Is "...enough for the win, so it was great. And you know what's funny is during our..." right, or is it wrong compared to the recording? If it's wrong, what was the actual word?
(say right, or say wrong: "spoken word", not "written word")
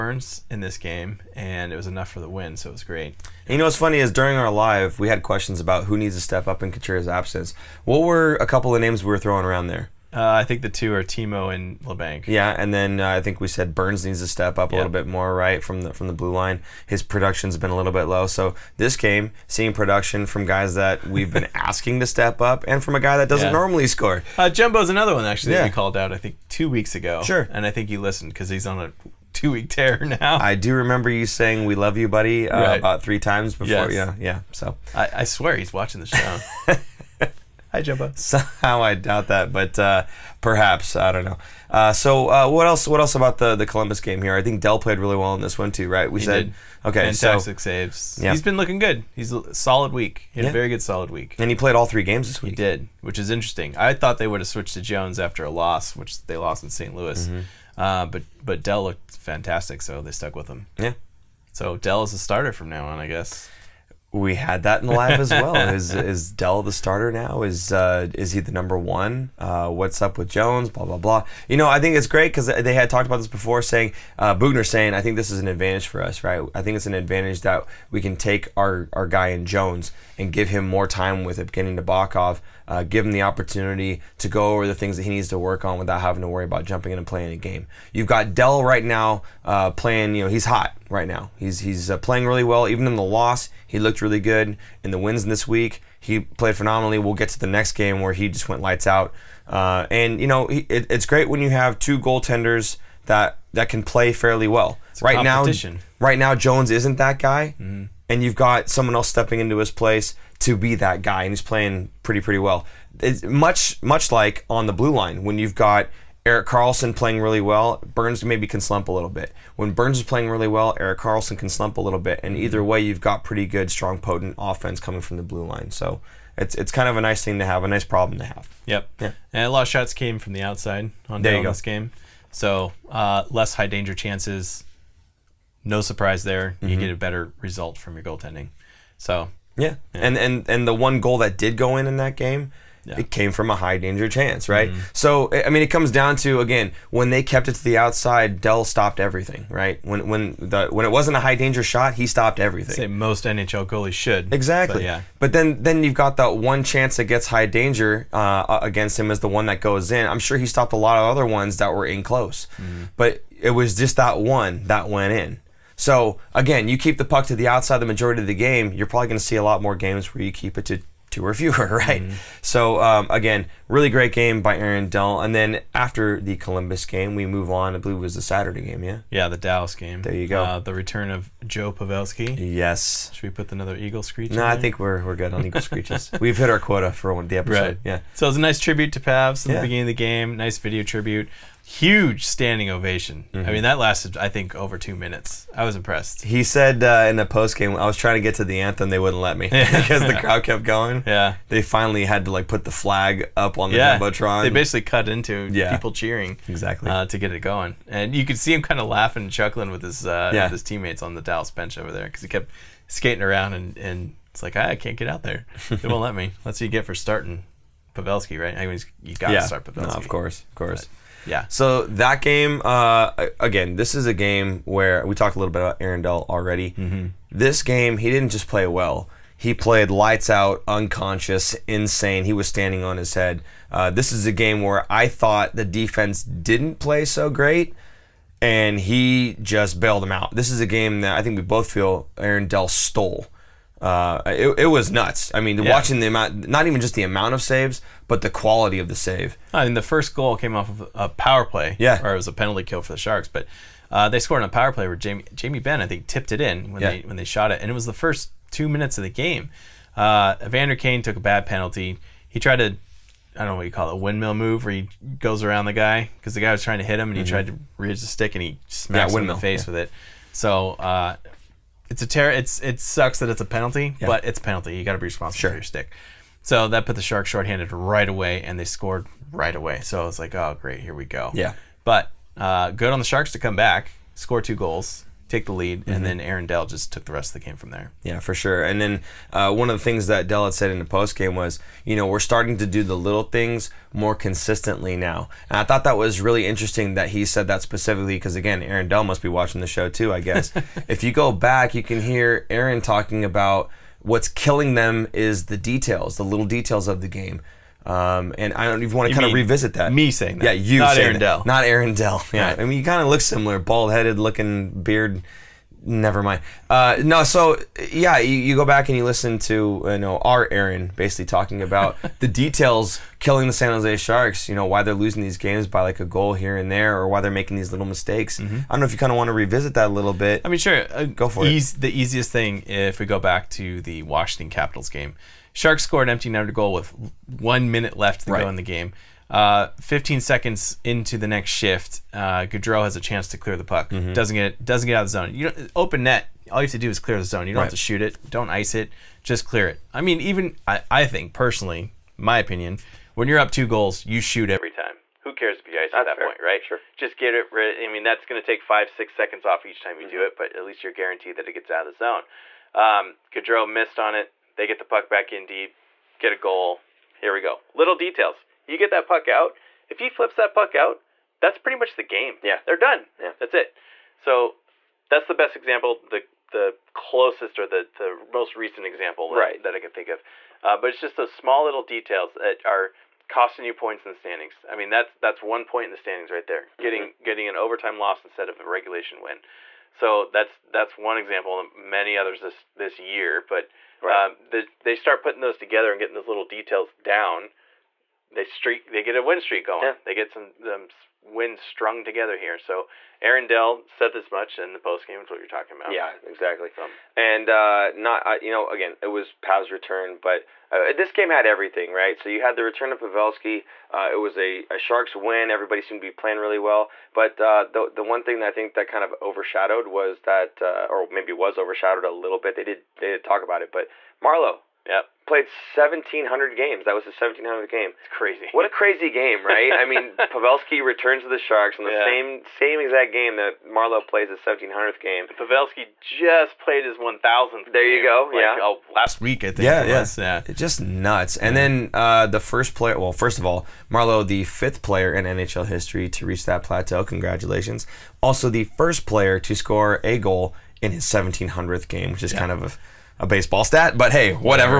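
right.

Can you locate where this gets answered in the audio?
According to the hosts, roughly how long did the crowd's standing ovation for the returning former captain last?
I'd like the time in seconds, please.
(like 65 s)
194 s.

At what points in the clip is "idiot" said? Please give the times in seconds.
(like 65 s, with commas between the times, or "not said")
not said.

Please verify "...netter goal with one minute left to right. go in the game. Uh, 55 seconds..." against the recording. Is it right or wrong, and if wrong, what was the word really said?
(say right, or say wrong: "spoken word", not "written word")
wrong: "15", not "55".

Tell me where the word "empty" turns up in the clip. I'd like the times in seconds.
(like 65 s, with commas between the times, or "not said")
336 s.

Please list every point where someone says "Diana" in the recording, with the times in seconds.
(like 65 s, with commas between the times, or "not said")
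not said.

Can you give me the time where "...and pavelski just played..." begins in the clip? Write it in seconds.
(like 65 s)
435 s.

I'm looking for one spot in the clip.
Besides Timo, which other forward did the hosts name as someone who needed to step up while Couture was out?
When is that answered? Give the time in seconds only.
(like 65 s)
11 s.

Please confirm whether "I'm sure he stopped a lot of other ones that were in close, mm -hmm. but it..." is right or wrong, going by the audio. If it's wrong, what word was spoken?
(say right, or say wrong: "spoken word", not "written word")
right.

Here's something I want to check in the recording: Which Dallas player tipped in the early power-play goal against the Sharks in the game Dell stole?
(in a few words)
Jamie Benn.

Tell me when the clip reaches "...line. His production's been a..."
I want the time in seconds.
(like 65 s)
16 s.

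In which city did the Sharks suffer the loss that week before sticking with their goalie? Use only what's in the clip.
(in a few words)
St. Louis.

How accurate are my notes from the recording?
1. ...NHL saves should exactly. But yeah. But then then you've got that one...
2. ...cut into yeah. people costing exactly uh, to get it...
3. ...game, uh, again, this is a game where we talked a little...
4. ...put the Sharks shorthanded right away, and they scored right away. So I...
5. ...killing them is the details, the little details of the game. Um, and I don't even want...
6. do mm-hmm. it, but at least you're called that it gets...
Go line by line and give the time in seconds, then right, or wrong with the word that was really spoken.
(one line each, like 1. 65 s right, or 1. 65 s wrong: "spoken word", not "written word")
1. 153 s wrong: "goalies", not "saves"
2. 204 s wrong: "cheering", not "costing"
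3. 222 s right
4. 276 s right
5. 304 s right
6. 360 s wrong: "guaranteed", not "called".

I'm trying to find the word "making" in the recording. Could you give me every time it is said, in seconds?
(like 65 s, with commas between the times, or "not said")
327 s.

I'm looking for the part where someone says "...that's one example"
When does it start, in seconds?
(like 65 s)
390 s.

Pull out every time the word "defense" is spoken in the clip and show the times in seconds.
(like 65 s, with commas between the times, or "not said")
235 s.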